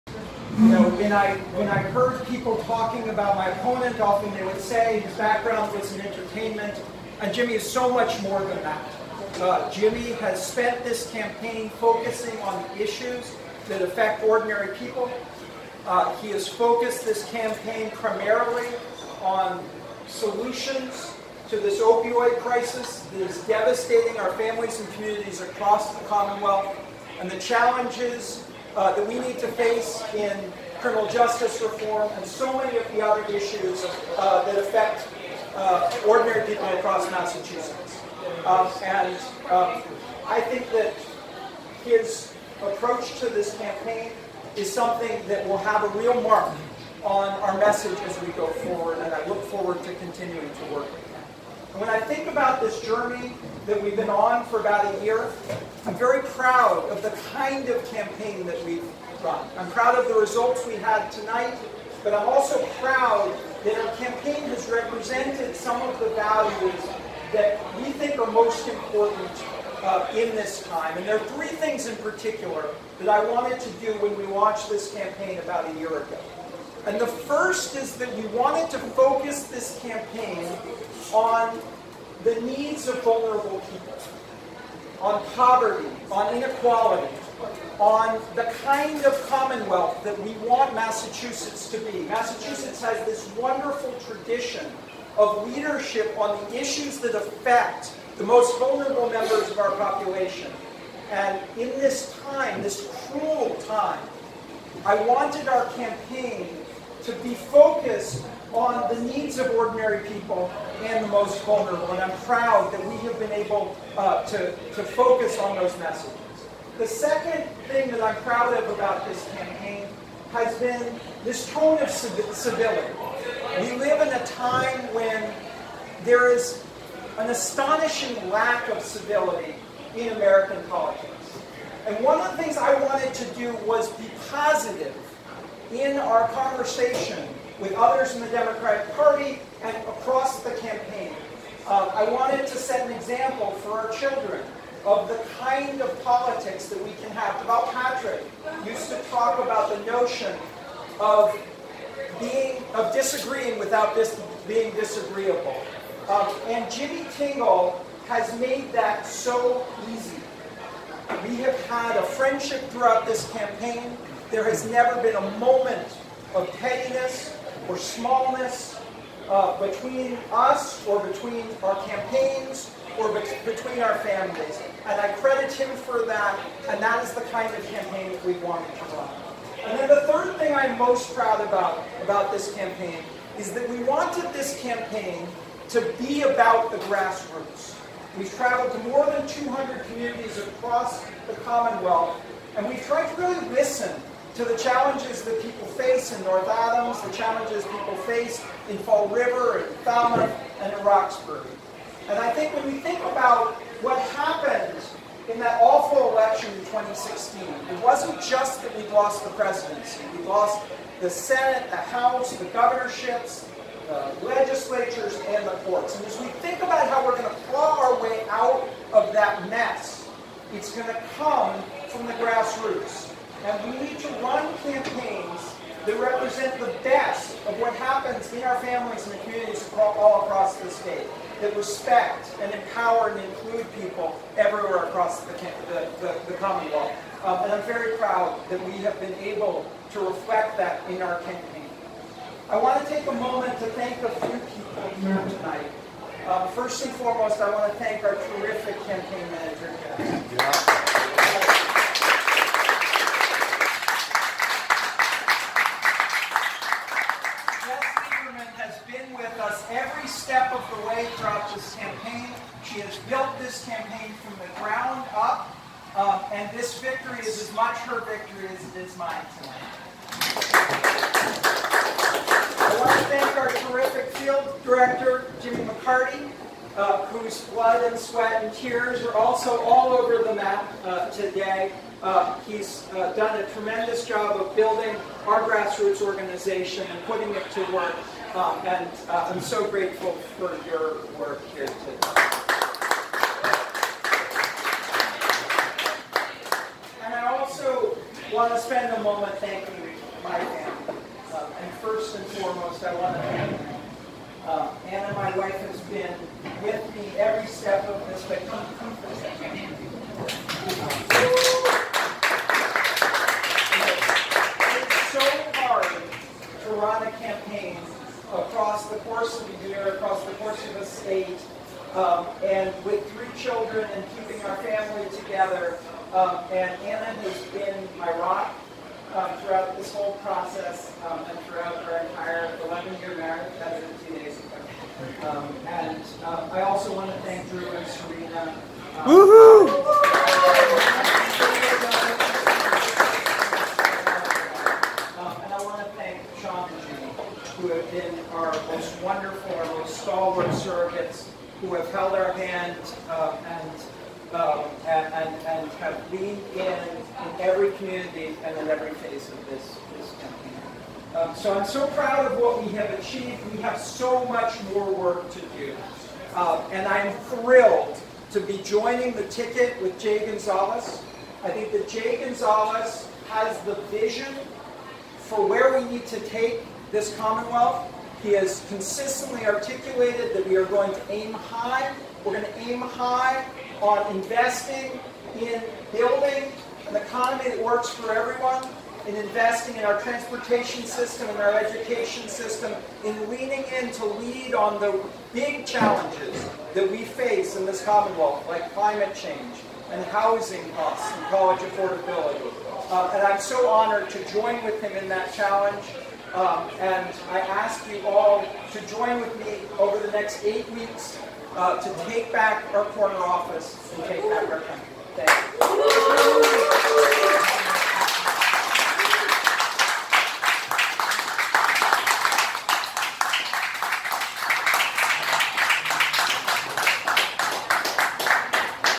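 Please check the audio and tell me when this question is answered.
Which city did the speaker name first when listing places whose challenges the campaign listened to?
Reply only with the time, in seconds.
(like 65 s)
196 s.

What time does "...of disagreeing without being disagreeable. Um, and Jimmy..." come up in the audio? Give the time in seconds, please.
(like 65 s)
152 s.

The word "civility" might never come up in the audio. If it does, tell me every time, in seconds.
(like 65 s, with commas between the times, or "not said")
121 s, 128 s.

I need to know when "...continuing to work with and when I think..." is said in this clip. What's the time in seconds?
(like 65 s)
49 s.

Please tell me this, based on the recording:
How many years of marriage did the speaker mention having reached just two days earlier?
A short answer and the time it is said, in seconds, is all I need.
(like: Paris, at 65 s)
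11, at 332 s.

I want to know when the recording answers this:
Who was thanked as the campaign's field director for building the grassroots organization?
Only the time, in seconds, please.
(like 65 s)
275 s.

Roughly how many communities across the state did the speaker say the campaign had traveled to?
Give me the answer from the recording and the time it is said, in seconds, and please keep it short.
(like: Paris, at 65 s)
200, at 189 s.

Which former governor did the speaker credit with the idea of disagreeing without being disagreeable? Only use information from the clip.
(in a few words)
Deval Patrick.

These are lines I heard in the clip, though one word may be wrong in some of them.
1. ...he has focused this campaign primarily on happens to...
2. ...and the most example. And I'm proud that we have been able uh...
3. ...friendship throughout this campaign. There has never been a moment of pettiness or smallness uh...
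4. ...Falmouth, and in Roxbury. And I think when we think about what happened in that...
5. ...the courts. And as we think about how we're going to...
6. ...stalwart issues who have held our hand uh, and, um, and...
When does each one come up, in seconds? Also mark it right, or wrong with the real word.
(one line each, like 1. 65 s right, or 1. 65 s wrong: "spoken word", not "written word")
1. 16 s wrong: "solutions", not "happens"
2. 110 s wrong: "vulnerable", not "example"
3. 162 s right
4. 199 s right
5. 215 s right
6. 350 s wrong: "surrogates", not "issues".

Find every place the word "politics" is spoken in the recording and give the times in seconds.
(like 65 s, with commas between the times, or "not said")
130 s, 146 s.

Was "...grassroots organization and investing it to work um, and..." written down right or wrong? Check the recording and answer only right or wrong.
wrong.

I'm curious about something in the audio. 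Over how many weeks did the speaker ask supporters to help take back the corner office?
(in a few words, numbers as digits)
8.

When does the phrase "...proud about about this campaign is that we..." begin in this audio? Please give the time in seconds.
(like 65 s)
181 s.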